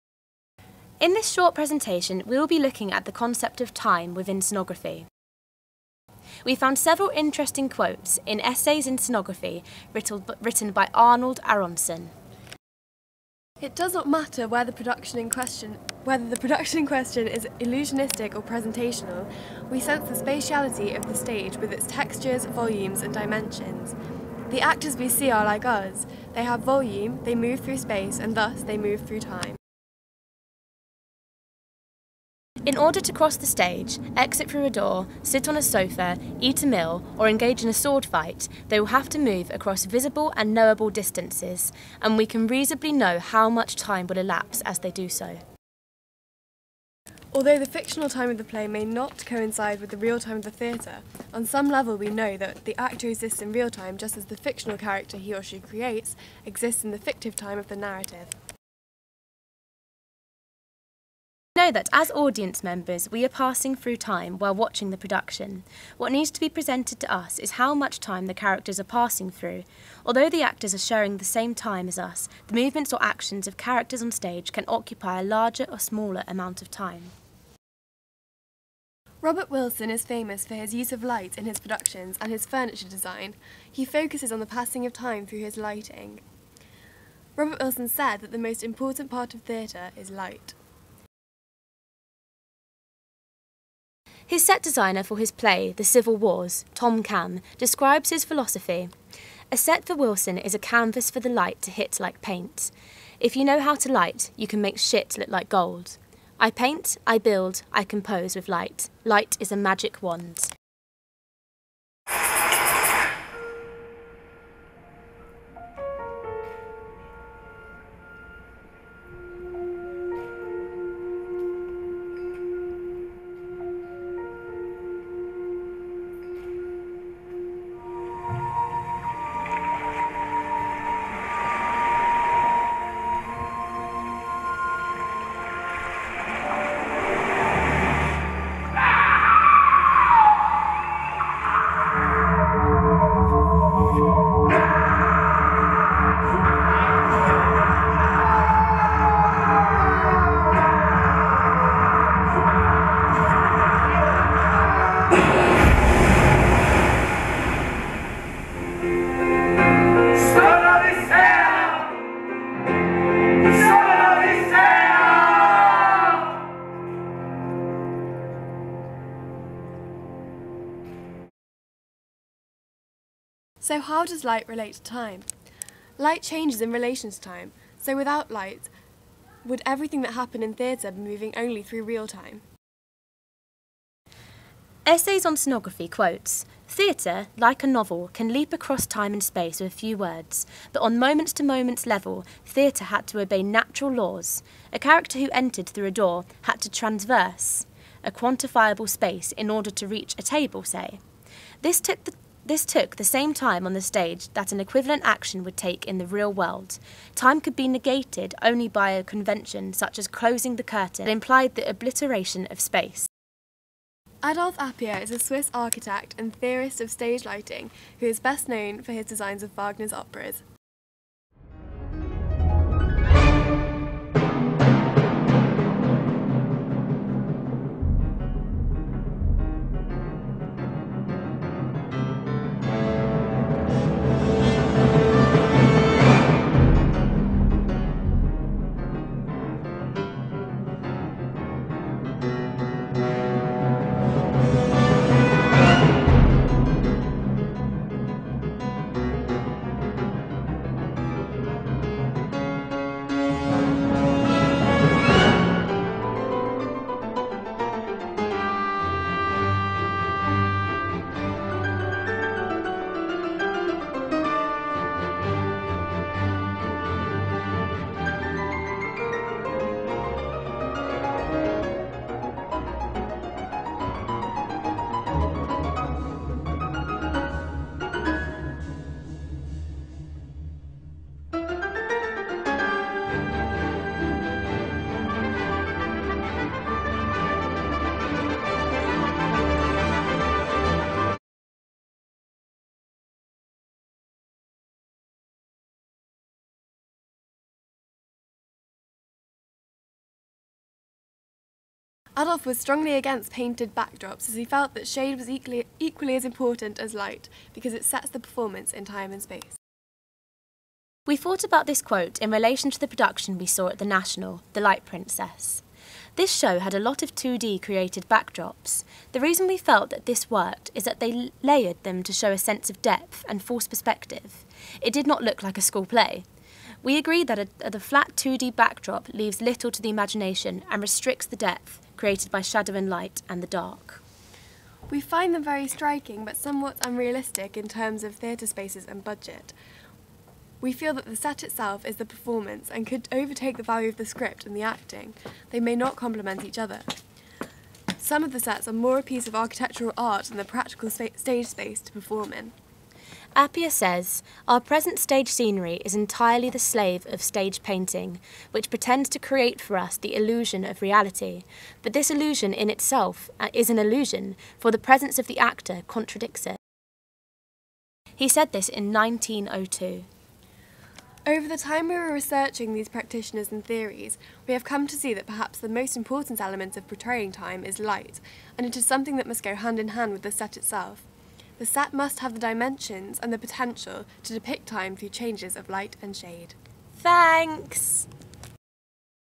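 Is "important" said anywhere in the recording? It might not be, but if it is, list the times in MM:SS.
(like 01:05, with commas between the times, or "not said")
01:28, 05:06, 06:15.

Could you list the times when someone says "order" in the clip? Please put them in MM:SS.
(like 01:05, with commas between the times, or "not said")
00:32, 03:19.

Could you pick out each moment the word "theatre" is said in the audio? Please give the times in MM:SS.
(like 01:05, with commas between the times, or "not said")
00:50, 01:29, 03:00, 03:06, 03:12, 05:38.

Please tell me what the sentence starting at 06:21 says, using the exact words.
The set must have the dimensions and the potential to depict time through changes of light and shade.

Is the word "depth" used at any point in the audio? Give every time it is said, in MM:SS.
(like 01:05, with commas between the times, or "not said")
05:22, 05:31.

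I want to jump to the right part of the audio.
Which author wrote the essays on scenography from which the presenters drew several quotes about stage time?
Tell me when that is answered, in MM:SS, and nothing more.
00:10.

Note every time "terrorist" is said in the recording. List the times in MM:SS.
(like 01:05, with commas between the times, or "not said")
not said.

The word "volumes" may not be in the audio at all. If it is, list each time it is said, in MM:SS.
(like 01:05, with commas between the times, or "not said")
00:22, 00:26.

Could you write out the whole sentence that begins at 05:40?
We feel that the set itself is the performance and could overtake the value of the script and the acting.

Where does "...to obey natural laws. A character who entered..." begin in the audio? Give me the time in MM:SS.
03:13.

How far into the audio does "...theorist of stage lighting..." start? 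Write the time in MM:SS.
03:36.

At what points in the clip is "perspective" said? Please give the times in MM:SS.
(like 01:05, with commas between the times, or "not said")
05:23.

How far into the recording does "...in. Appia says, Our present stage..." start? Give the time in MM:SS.
05:52.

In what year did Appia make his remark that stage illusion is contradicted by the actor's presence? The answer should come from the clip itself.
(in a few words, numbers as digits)
1902.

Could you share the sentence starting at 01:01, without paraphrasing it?
Know that as audience members, we are passing through time while watching the production.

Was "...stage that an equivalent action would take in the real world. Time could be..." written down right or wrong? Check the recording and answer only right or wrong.
right.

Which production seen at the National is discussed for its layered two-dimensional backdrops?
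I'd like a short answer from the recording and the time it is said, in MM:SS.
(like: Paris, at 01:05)
The Light Princess, at 05:14.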